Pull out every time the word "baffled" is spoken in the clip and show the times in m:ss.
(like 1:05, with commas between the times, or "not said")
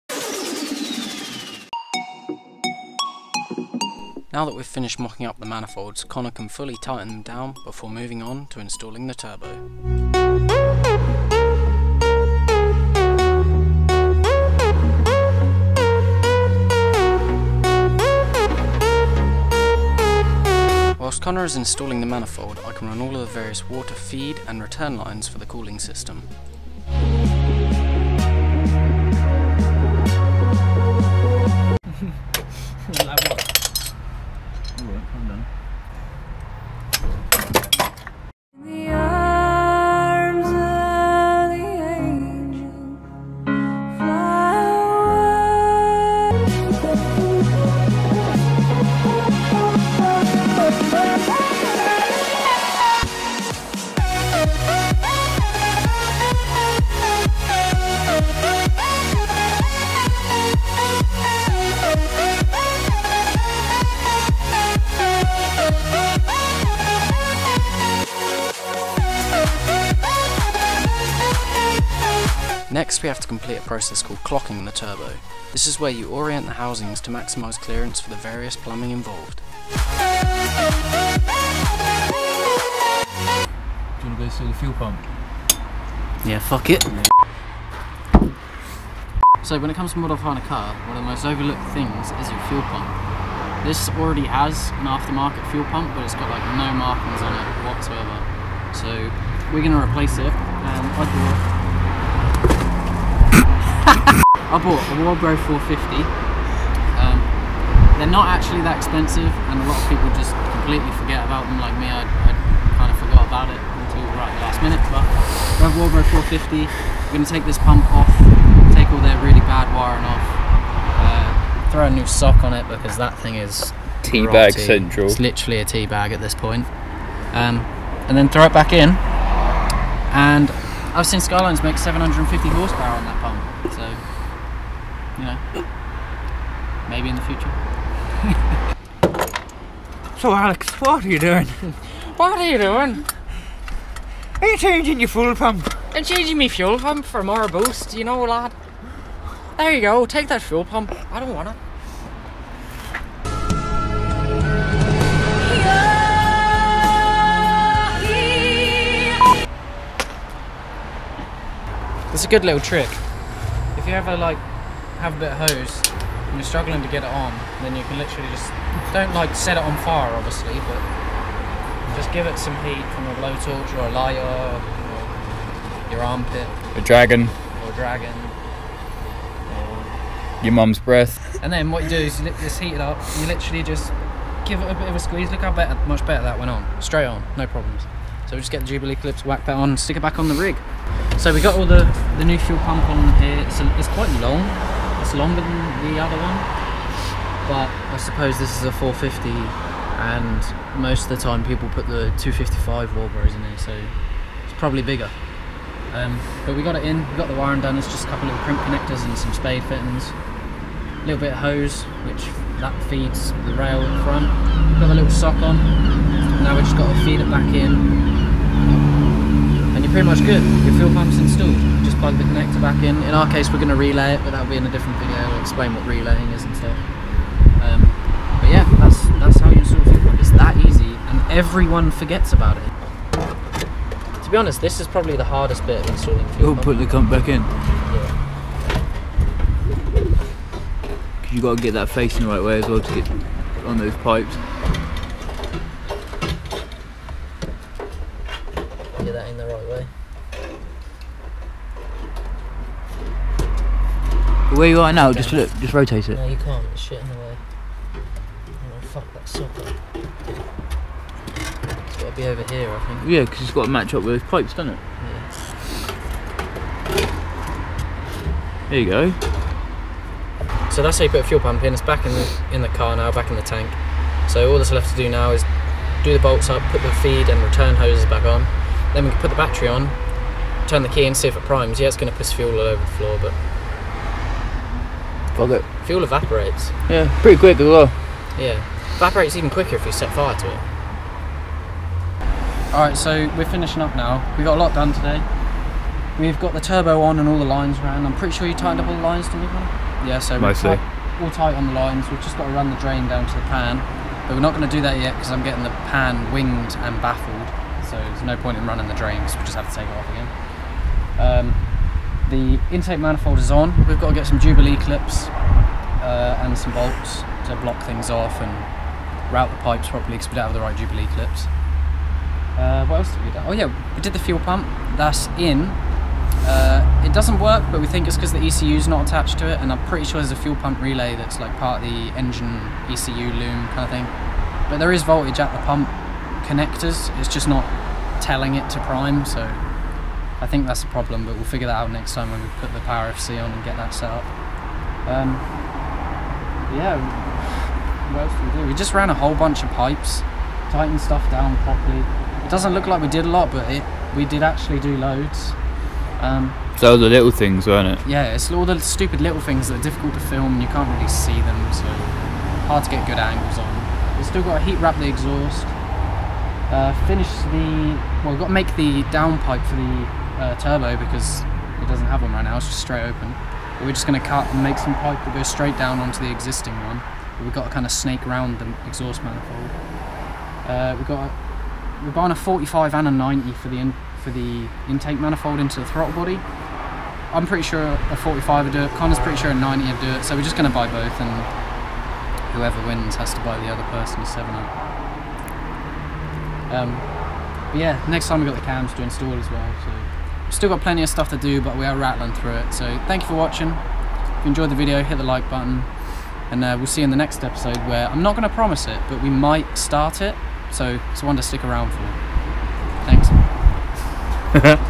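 5:07.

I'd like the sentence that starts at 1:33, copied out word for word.
This already has an aftermarket fuel pump, but it's got like no markings on it whatsoever.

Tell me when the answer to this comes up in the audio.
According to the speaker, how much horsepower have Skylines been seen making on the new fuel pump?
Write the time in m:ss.
2:11.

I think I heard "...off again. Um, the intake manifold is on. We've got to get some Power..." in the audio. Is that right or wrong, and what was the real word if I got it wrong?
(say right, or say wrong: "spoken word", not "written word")
wrong: "Jubilee", not "Power".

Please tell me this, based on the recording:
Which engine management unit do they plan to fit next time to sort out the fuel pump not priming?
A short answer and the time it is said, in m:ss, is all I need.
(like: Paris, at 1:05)
Power FC, at 5:42.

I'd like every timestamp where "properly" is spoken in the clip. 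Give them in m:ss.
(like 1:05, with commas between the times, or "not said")
5:19, 5:51.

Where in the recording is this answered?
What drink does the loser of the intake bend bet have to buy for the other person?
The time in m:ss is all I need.
6:34.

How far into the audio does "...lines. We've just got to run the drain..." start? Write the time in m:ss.
5:01.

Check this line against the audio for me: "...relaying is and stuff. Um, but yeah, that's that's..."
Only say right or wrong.
right.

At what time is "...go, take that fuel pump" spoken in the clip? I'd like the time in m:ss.
2:29.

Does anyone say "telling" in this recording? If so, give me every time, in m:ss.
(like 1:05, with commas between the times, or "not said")
5:38.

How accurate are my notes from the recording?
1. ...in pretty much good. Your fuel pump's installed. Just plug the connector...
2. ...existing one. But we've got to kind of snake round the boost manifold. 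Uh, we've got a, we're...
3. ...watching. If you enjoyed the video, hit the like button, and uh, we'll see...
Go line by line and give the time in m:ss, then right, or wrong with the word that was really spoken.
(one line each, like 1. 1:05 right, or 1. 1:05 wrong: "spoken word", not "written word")
1. 3:37 right
2. 6:16 wrong: "exhaust", not "boost"
3. 6:43 right.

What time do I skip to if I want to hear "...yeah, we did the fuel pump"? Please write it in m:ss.
5:23.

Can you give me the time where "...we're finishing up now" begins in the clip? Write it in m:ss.
4:53.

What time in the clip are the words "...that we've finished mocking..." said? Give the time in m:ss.
0:04.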